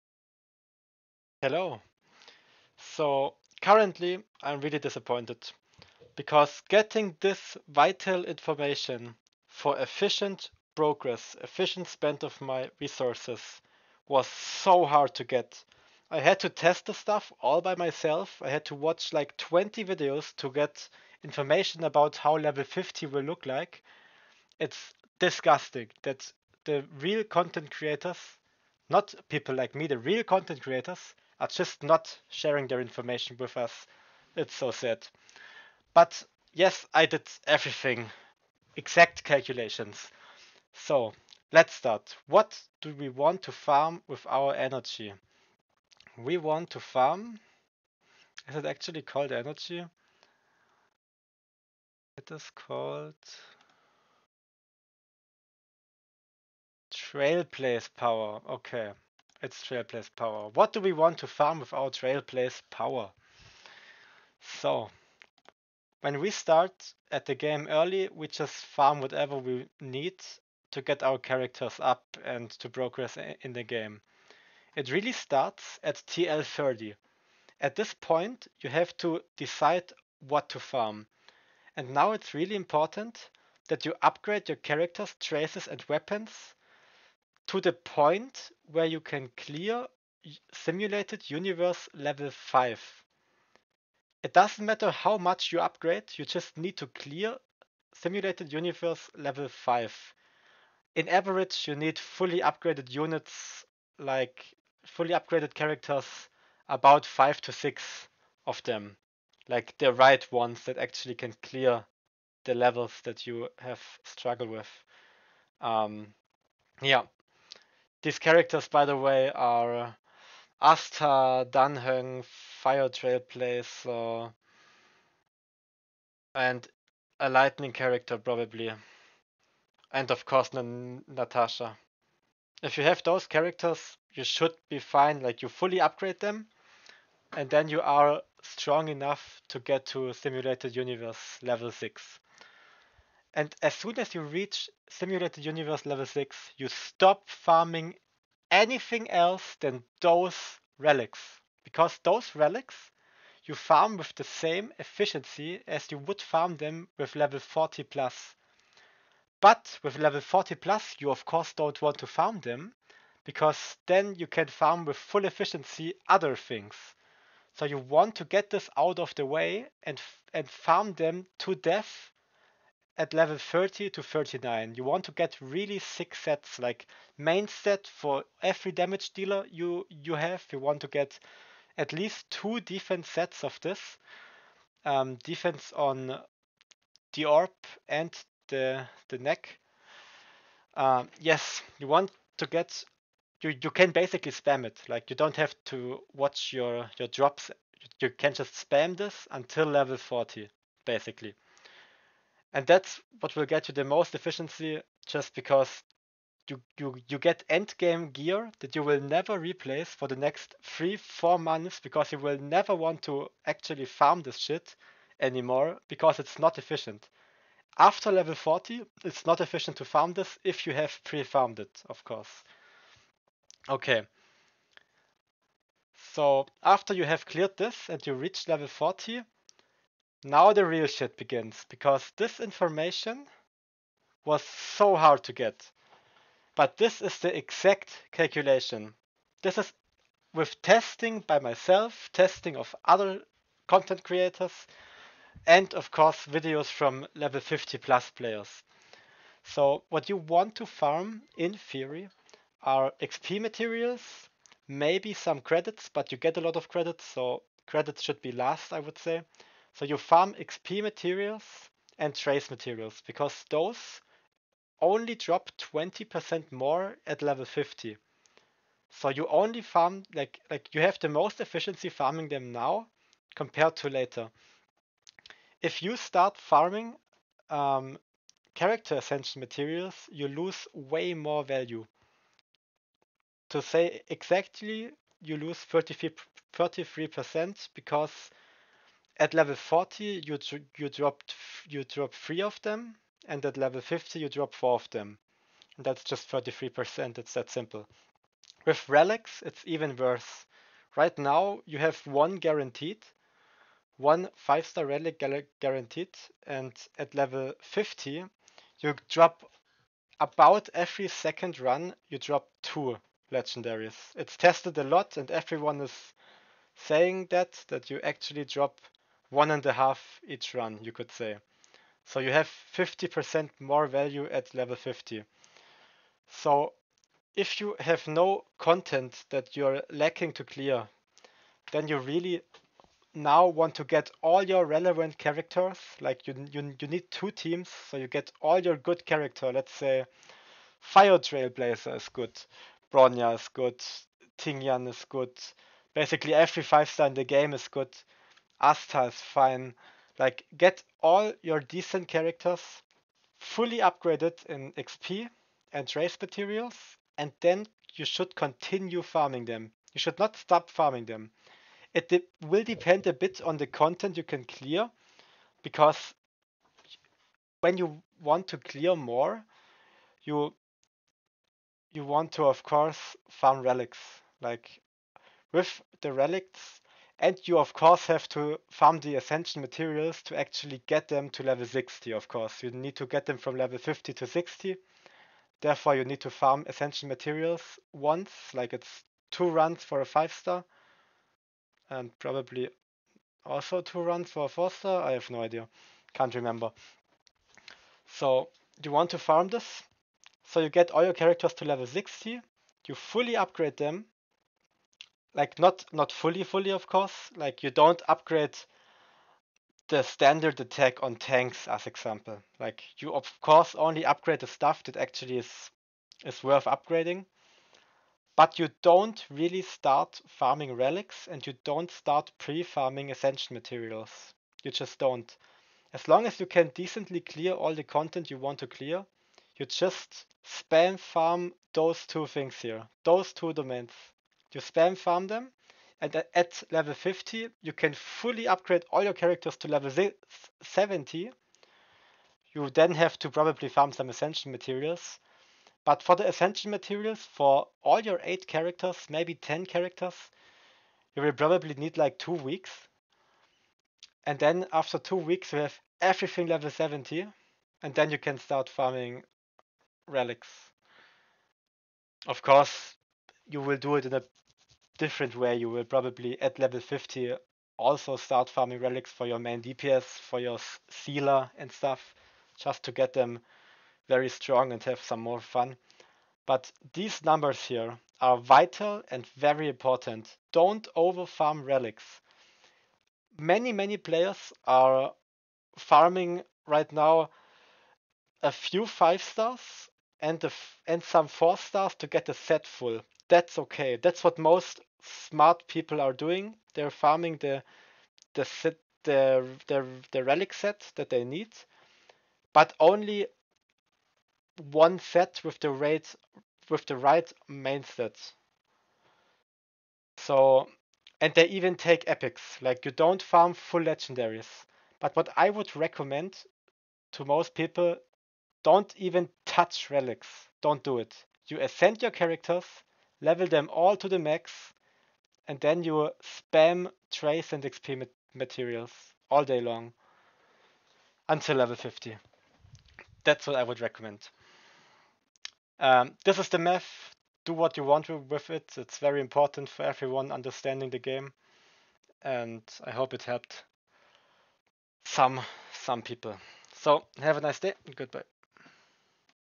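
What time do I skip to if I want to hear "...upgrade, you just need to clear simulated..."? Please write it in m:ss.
1:35.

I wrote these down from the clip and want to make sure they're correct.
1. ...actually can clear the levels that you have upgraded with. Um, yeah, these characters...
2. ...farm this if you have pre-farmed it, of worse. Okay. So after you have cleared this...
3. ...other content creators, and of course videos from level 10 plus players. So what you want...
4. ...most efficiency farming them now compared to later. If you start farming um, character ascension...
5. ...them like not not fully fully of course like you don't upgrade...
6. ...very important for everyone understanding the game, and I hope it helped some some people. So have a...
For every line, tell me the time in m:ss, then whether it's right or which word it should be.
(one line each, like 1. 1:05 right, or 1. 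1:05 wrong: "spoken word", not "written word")
1. 1:50 wrong: "struggled", not "upgraded"
2. 3:39 wrong: "course", not "worse"
3. 4:02 wrong: "50", not "10"
4. 4:31 right
5. 6:43 right
6. 8:58 right.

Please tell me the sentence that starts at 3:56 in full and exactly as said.
But this is the exact calculation.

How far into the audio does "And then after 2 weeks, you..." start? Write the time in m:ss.
7:34.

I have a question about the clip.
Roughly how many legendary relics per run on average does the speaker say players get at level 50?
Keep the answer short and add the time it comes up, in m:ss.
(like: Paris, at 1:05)
1.5, at 5:19.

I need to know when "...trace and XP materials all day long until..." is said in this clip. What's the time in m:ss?
8:47.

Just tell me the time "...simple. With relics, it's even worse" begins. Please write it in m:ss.
4:57.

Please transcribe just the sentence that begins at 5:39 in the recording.
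Let's say Fire Trailblazer is good, Bronya is good, Tingyun is good.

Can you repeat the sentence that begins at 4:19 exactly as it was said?
So you farm XP materials and trace materials because those only drop 20% more at level 50.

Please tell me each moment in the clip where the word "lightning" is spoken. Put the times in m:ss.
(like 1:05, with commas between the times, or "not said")
2:07.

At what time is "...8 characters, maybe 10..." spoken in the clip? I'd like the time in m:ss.
7:28.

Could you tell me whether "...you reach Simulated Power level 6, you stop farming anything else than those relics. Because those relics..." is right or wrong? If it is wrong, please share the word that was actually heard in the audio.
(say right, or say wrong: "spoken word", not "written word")
wrong: "Universe", not "Power".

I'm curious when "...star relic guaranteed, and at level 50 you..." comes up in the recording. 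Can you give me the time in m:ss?
5:04.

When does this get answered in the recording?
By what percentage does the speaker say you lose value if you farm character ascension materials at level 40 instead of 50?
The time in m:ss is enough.
4:45.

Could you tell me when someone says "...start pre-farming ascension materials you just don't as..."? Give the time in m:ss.
7:01.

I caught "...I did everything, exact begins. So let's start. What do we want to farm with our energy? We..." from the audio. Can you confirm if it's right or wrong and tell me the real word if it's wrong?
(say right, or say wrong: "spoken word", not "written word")
wrong: "calculations", not "begins".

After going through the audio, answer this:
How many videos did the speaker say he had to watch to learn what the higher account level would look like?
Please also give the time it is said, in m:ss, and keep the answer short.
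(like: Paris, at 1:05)
20, at 0:19.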